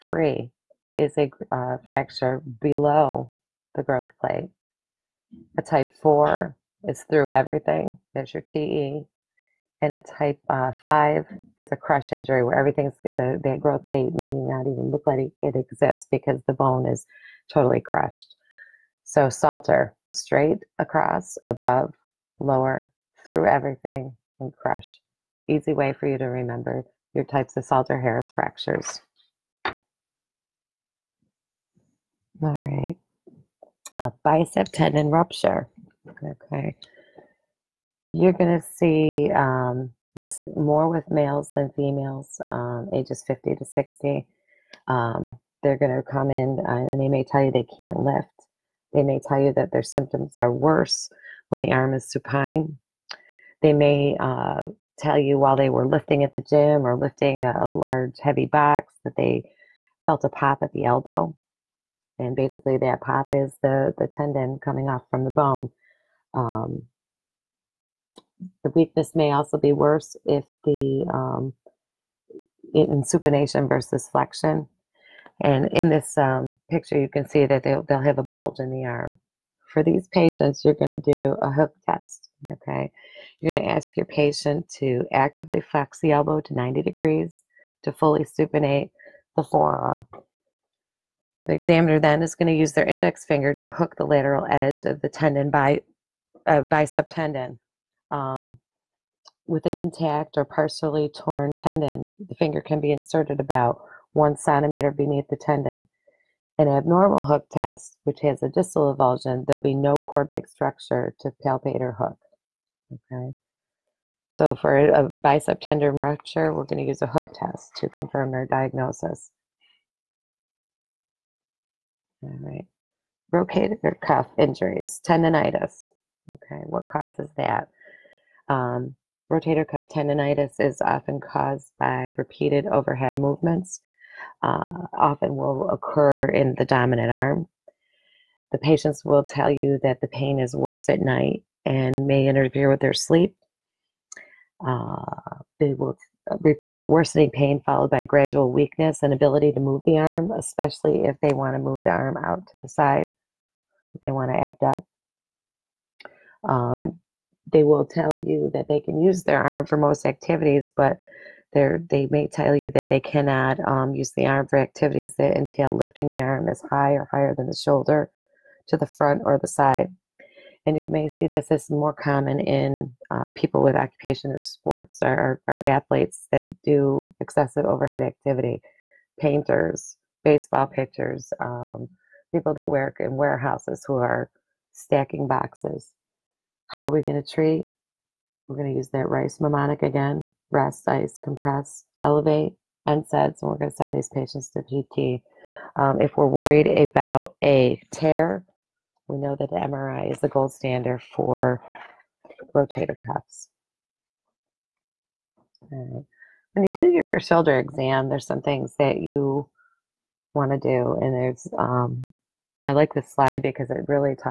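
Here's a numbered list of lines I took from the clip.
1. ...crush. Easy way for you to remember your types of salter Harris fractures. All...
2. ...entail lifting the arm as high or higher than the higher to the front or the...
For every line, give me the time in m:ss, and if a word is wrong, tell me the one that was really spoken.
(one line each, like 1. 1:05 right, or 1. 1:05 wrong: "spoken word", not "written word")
1. 0:24 right
2. 2:45 wrong: "shoulder", not "higher".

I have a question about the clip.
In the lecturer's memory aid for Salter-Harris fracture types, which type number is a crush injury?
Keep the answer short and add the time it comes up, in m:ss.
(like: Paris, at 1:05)
5, at 0:10.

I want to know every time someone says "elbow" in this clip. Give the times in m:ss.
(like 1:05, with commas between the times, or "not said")
1:00, 1:26.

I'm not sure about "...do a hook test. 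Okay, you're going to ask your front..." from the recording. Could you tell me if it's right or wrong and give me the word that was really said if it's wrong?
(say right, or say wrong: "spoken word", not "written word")
wrong: "patient", not "front".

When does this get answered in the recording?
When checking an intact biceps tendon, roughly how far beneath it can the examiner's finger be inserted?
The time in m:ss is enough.
1:44.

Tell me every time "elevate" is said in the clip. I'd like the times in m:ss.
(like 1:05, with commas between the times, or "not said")
3:12.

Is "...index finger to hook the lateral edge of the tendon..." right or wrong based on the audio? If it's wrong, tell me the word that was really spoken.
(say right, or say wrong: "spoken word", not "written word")
right.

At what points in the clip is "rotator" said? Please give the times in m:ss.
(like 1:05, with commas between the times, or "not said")
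2:03, 2:09, 3:22.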